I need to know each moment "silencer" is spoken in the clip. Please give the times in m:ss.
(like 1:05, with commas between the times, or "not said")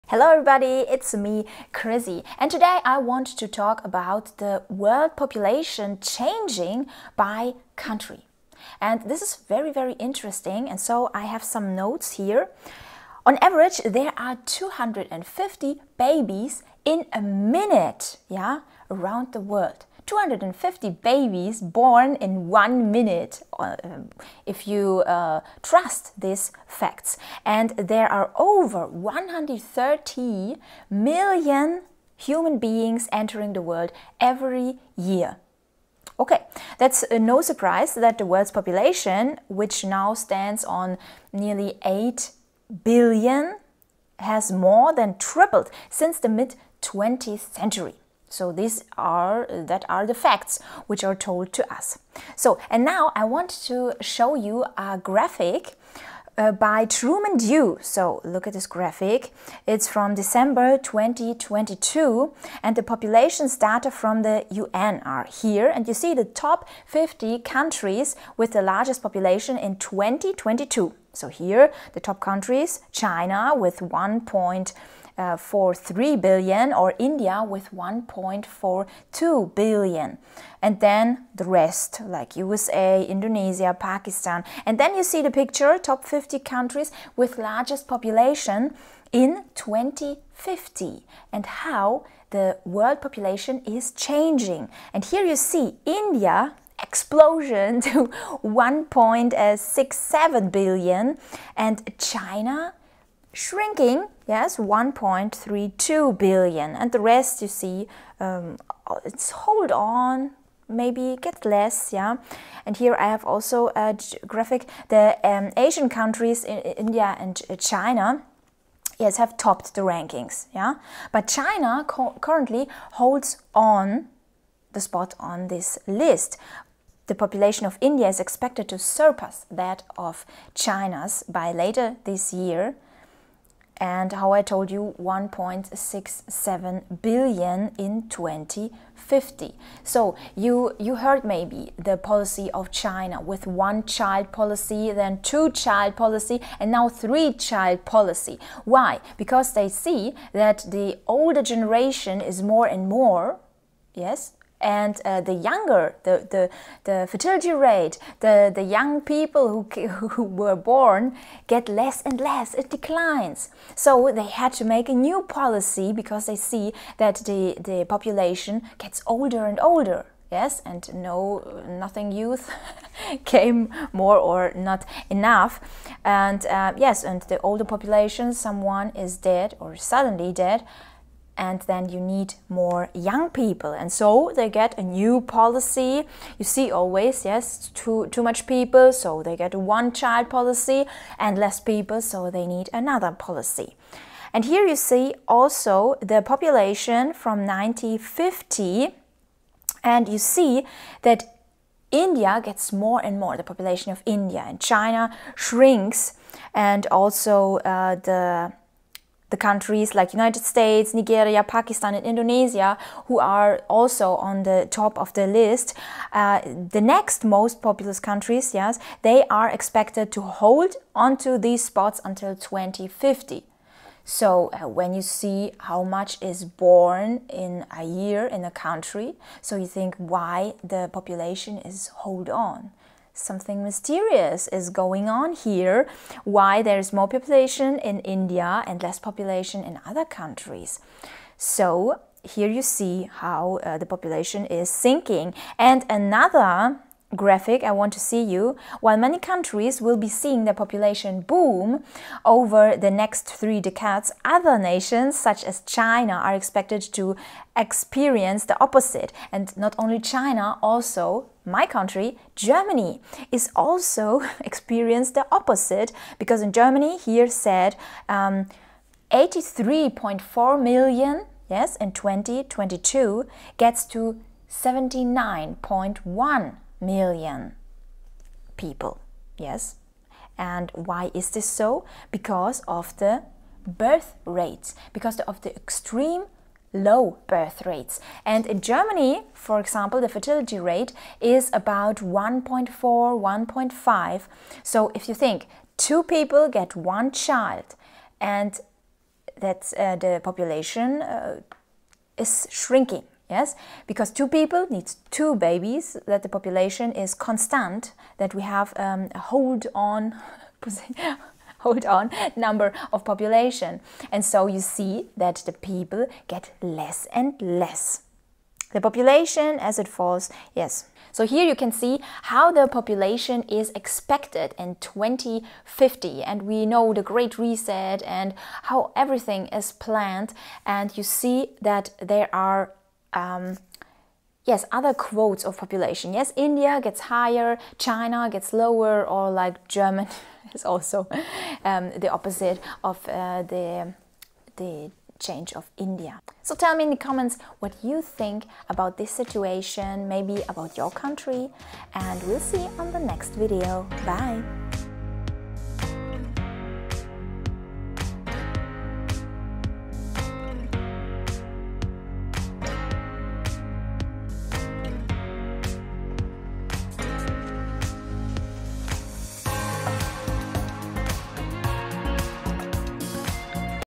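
not said.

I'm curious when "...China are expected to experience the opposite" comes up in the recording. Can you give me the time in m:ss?
4:15.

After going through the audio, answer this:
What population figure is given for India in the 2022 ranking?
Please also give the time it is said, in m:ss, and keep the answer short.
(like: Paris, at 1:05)
1.42 billion, at 1:17.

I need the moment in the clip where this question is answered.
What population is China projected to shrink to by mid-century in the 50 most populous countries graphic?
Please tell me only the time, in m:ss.
1:44.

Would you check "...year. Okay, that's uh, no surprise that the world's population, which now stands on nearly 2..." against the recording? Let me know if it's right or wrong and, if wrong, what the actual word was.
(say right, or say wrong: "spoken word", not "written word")
wrong: "8", not "2".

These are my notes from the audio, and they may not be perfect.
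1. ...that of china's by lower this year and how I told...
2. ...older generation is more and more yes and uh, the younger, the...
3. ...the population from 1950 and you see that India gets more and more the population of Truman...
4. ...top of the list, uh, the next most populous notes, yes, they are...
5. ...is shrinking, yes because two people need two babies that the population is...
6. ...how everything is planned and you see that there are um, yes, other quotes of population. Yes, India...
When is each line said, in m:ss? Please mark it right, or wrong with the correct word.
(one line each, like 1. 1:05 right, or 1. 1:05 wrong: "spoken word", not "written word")
1. 2:09 wrong: "later", not "lower"
2. 2:31 right
3. 3:16 wrong: "India", not "Truman"
4. 3:34 wrong: "countries", not "notes"
5. 5:02 right
6. 5:28 right.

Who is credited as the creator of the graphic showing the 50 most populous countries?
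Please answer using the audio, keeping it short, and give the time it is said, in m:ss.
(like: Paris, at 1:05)
Truman Du, at 0:56.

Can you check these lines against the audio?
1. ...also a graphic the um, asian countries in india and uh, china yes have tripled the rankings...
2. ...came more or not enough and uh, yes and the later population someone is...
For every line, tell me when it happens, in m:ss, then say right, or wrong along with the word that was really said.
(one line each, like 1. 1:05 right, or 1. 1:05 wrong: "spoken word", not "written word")
1. 1:53 wrong: "topped", not "tripled"
2. 2:53 wrong: "older", not "later".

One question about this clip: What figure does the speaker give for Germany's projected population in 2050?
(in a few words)
79.1 million.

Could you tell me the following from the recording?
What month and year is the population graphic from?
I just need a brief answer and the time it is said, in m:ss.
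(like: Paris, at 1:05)
December 2022, at 1:00.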